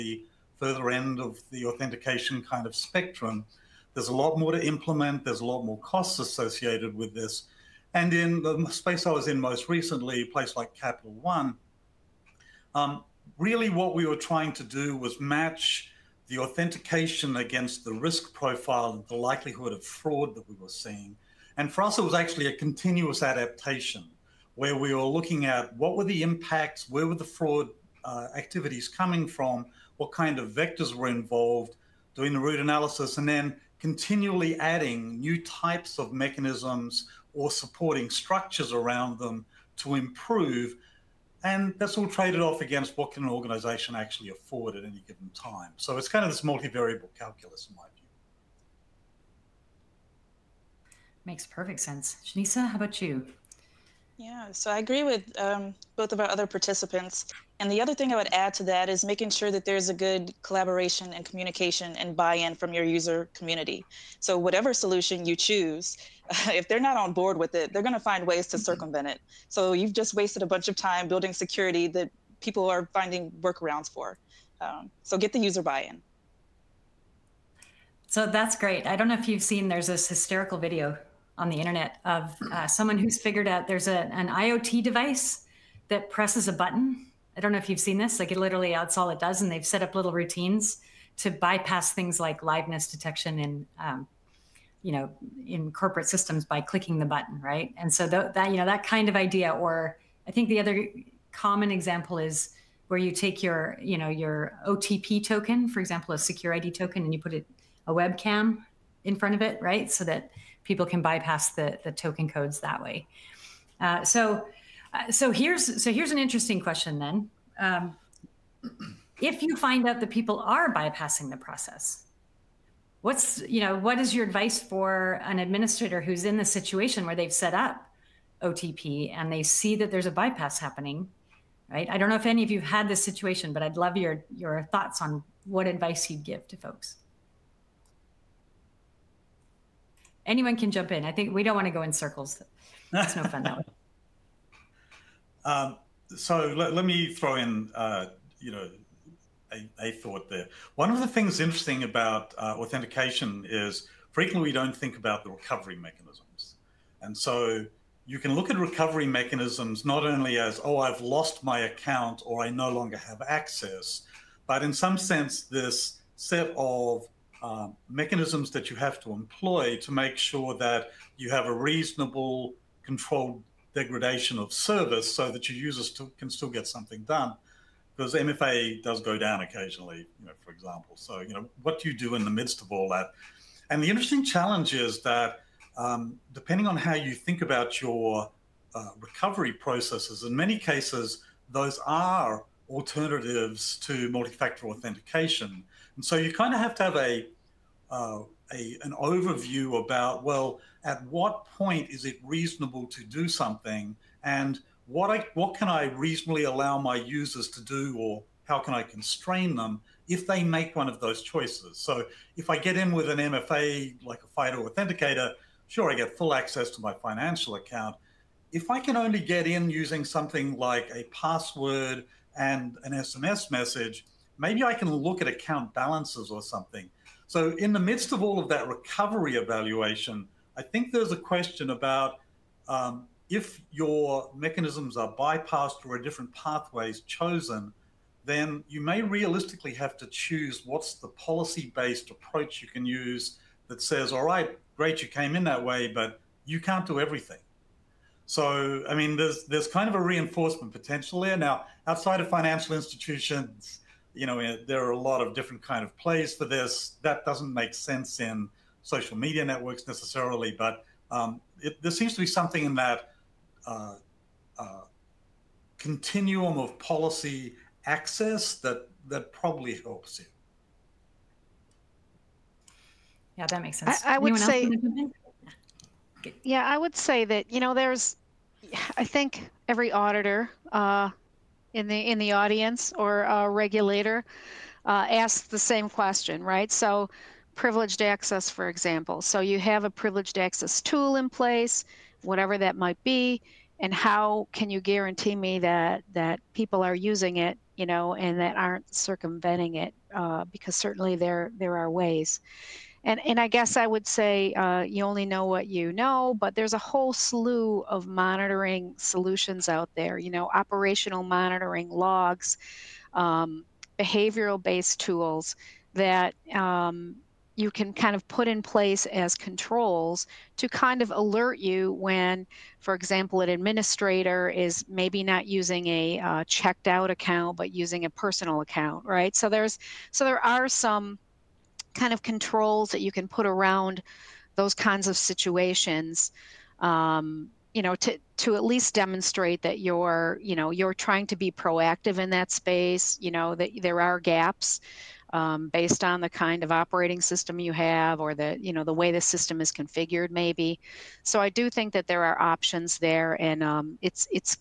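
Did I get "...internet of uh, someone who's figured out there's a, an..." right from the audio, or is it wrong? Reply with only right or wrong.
right.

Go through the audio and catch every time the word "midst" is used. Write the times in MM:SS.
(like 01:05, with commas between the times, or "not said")
03:02, 03:47.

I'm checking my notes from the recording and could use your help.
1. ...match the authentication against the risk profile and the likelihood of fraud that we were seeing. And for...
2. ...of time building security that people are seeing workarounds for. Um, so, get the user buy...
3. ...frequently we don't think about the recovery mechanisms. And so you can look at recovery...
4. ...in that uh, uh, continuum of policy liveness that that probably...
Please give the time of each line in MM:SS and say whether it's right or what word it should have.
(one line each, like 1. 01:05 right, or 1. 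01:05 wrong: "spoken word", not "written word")
1. 00:15 right
2. 01:10 wrong: "finding", not "seeing"
3. 02:34 right
4. 04:22 wrong: "access", not "liveness".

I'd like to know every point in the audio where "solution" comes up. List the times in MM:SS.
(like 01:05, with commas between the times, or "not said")
01:04, 05:08.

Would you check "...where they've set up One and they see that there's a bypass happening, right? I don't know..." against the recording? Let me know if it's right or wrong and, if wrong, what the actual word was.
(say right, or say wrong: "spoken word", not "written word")
wrong: "OTP", not "One".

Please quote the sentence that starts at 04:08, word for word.
So, I mean, there's, there's kind of a reinforcement potential there.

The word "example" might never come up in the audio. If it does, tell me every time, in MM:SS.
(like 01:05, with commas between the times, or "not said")
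01:41, 01:45, 03:00, 04:48, 05:22.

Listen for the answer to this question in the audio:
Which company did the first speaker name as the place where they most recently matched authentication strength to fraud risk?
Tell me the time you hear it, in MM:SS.
00:10.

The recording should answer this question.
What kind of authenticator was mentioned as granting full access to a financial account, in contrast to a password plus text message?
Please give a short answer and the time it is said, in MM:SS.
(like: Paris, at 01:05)
FIDO authenticator, at 03:34.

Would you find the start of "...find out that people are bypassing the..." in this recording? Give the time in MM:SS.
01:59.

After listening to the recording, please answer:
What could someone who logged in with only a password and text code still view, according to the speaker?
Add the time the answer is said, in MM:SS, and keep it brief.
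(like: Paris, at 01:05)
account balances, at 03:45.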